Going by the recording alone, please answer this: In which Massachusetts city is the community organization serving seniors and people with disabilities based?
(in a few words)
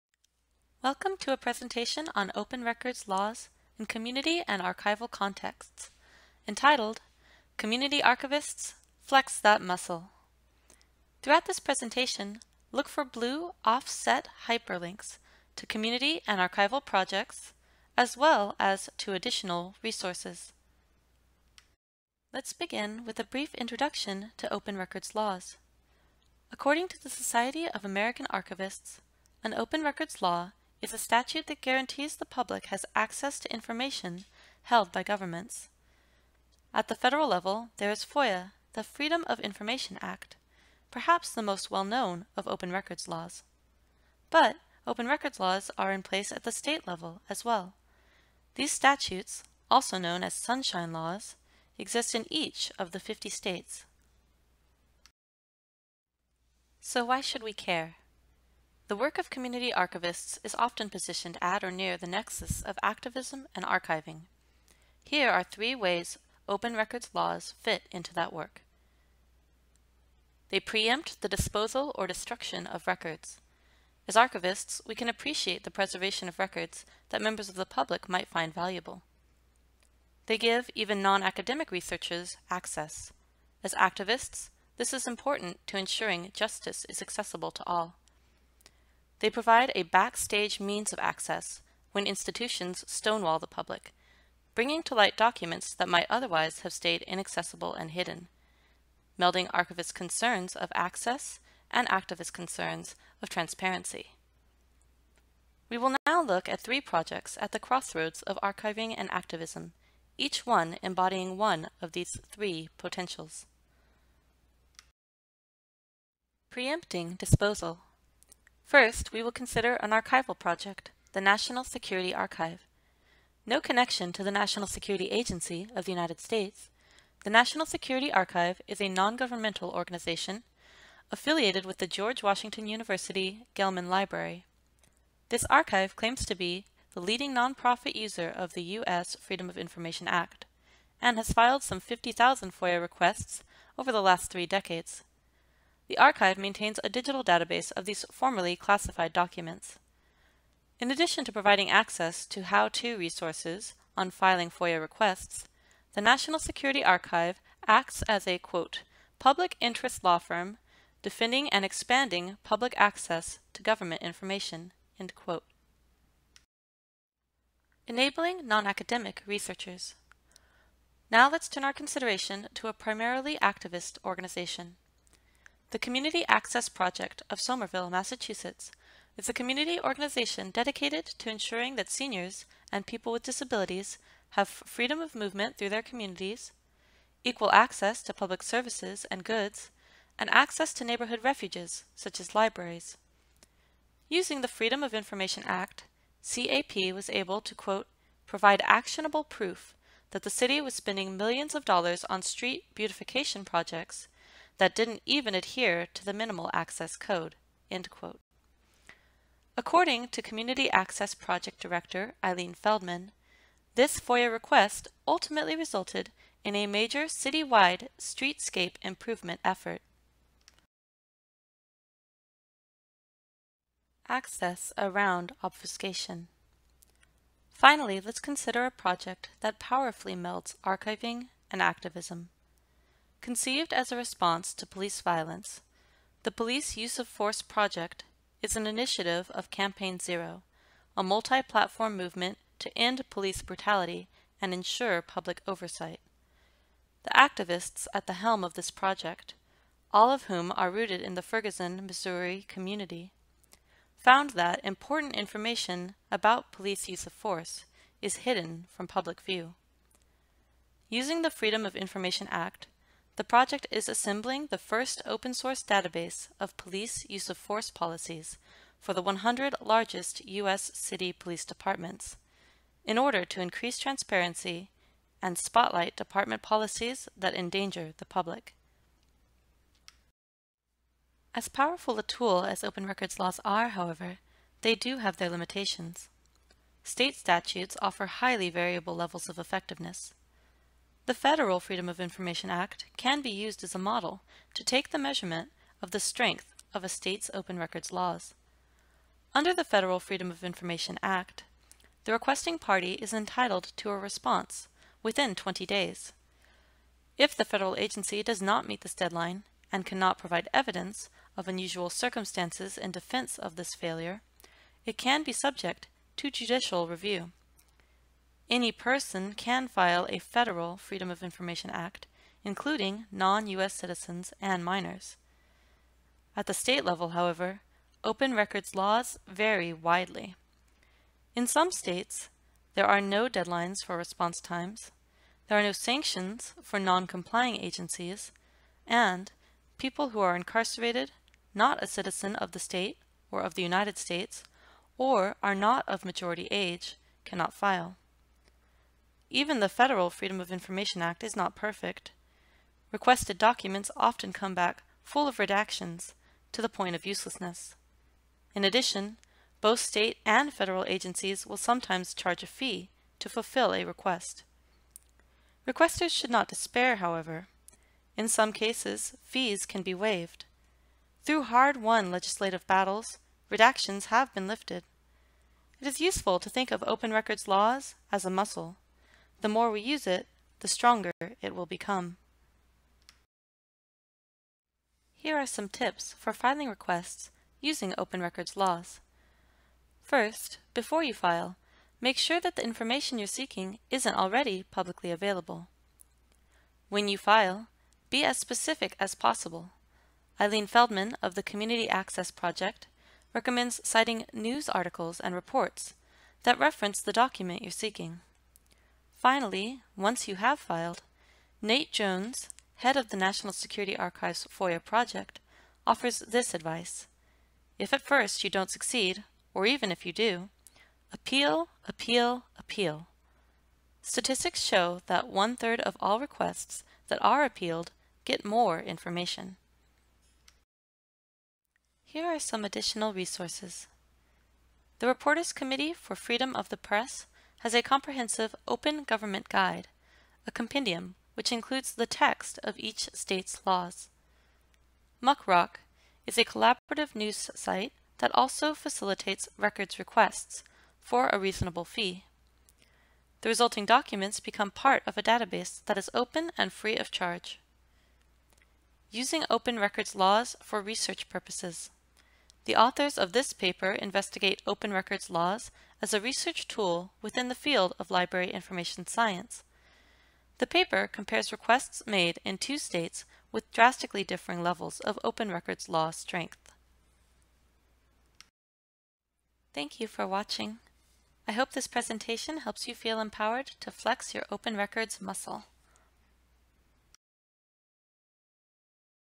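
Somerville.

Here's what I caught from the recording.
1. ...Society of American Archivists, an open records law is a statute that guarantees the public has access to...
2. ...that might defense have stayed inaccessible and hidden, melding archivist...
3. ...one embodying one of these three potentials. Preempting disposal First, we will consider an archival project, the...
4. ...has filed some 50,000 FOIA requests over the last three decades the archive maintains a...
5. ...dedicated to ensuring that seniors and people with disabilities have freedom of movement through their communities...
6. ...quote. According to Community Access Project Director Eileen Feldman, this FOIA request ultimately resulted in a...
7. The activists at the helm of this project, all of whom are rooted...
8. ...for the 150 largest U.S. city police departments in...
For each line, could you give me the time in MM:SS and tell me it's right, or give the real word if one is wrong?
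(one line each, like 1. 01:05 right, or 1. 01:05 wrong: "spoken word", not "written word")
1. 00:27 right
2. 01:35 wrong: "otherwise", not "defense"
3. 01:50 right
4. 02:21 right
5. 03:00 right
6. 03:27 right
7. 04:07 right
8. 04:28 wrong: "100", not "150".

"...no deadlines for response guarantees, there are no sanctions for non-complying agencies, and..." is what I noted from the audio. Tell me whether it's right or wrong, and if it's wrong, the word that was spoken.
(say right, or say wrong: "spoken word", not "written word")
wrong: "times", not "guarantees".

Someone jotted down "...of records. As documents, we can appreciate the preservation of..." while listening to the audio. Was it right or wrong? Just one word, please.
wrong.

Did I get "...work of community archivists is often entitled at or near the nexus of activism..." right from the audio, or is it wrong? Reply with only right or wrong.
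wrong.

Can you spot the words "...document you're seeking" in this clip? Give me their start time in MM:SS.
06:47.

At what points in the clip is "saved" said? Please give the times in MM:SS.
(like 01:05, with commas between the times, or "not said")
not said.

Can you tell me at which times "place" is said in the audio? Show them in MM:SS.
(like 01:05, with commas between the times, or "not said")
00:46.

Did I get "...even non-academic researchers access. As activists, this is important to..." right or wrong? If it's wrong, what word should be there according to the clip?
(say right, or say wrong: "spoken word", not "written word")
right.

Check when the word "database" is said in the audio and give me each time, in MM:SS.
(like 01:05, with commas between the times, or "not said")
02:27, 04:25, 07:35.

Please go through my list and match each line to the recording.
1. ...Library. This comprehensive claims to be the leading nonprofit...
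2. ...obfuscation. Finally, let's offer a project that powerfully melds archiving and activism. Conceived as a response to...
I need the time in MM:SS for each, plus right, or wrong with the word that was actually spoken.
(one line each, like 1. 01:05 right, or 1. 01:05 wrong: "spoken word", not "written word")
1. 02:13 wrong: "archive", not "comprehensive"
2. 03:45 wrong: "consider", not "offer".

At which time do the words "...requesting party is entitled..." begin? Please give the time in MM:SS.
05:02.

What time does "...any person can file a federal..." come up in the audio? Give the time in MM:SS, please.
05:18.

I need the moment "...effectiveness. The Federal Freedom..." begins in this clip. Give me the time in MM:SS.
04:49.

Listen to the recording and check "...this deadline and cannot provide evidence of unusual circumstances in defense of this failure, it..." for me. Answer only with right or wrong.
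right.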